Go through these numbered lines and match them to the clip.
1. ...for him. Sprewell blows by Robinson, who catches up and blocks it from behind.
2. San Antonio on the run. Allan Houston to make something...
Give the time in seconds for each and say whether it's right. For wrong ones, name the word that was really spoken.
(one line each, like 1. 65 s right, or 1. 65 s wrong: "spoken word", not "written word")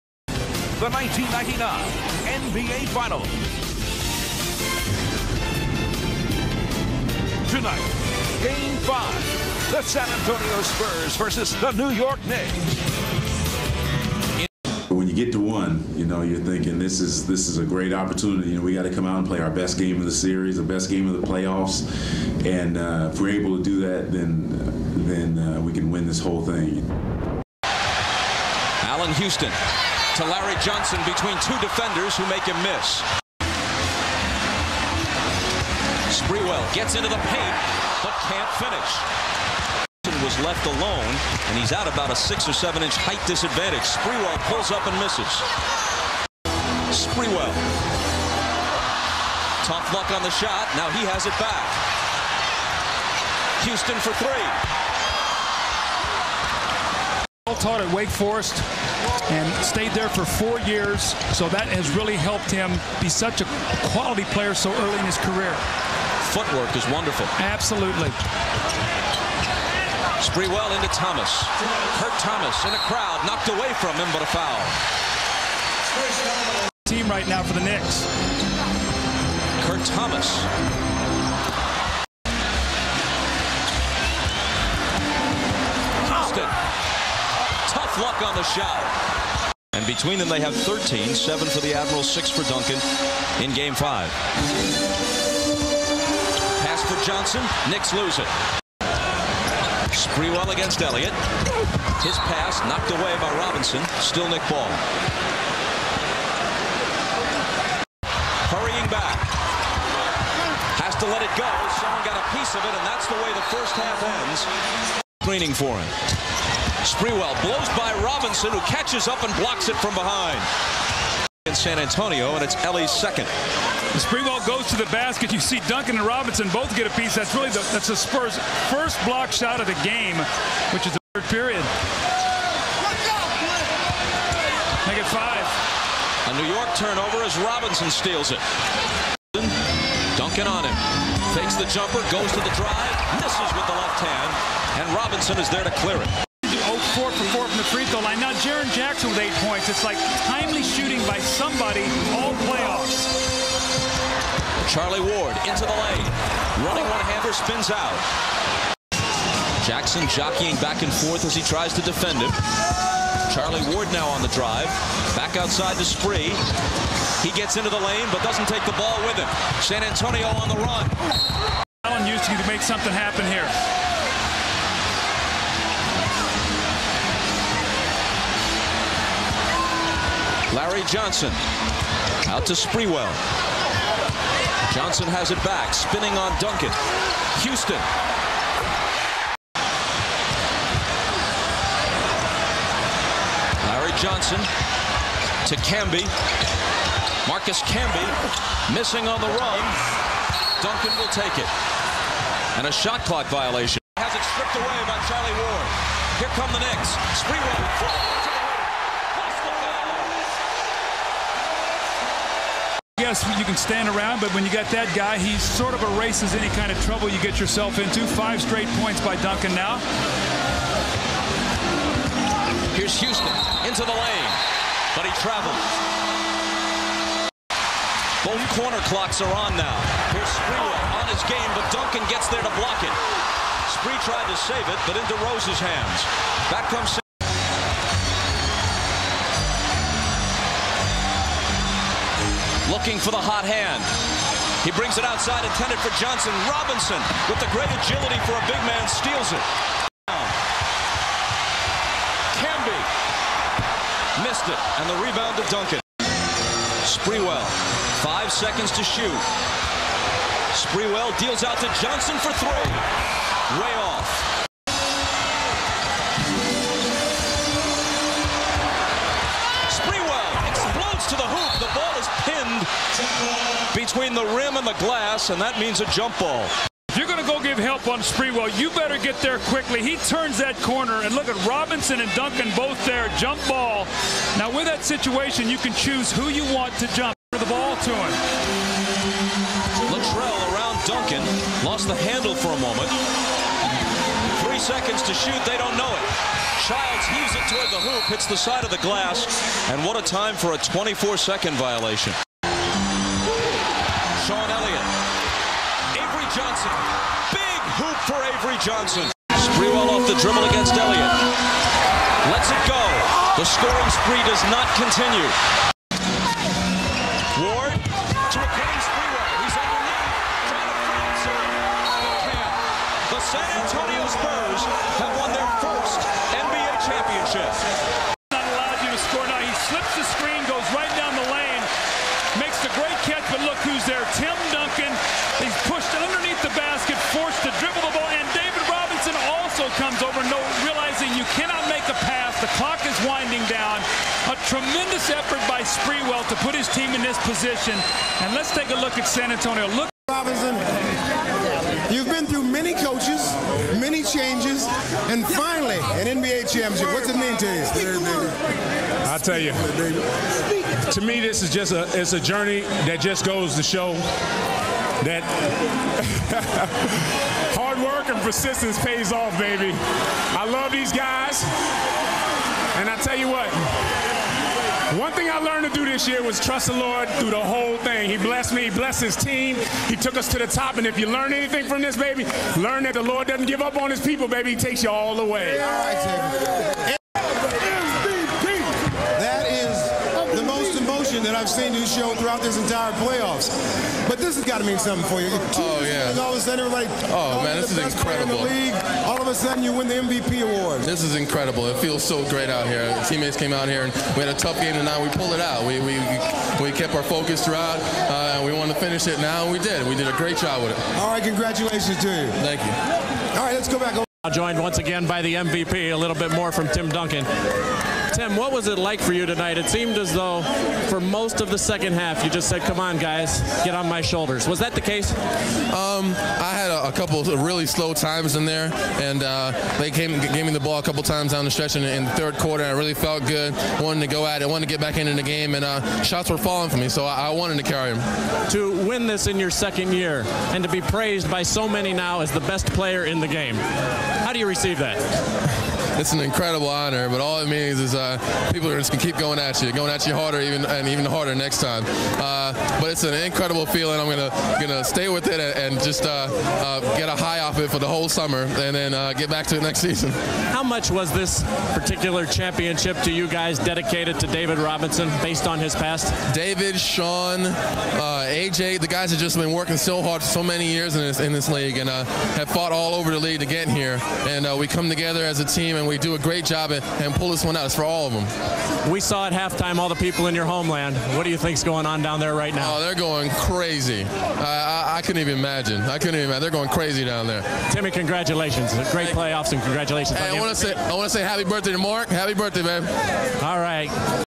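1. 115 s right
2. 169 s right.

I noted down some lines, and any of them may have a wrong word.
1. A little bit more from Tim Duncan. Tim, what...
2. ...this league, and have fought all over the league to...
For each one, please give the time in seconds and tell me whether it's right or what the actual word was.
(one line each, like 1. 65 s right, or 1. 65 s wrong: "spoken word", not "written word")
1. 415 s right
2. 471 s right.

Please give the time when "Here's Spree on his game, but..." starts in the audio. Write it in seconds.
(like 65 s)
230 s.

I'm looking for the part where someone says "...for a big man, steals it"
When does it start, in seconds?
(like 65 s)
248 s.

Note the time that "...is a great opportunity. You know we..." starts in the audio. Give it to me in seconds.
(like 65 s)
17 s.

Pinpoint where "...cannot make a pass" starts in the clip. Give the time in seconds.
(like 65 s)
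341 s.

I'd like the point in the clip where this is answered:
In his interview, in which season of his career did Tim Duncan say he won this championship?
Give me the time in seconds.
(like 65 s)
439 s.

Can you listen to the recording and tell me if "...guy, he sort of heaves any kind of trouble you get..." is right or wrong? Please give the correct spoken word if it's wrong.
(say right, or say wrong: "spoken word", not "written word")
wrong: "erases", not "heaves".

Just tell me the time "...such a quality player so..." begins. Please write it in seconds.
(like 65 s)
63 s.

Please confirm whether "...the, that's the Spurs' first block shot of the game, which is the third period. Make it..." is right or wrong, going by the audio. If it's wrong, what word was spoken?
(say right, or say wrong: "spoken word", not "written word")
right.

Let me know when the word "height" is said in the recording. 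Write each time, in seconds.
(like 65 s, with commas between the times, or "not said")
42 s.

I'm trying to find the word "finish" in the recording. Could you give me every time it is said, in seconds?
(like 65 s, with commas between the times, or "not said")
38 s, 408 s.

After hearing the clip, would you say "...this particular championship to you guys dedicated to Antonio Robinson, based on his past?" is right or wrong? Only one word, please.
wrong.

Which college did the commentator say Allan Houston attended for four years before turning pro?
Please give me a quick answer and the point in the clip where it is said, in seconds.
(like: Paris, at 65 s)
Wake Forest, at 57 s.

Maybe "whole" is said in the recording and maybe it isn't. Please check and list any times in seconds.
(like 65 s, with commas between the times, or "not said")
26 s, 377 s, 457 s.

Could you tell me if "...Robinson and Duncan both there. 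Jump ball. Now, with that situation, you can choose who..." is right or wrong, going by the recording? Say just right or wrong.
right.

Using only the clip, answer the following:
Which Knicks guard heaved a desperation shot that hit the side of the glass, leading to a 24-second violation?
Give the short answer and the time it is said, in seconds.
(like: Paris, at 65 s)
Childs, at 296 s.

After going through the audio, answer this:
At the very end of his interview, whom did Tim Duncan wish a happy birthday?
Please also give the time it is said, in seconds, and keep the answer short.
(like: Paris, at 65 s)
Mark, at 491 s.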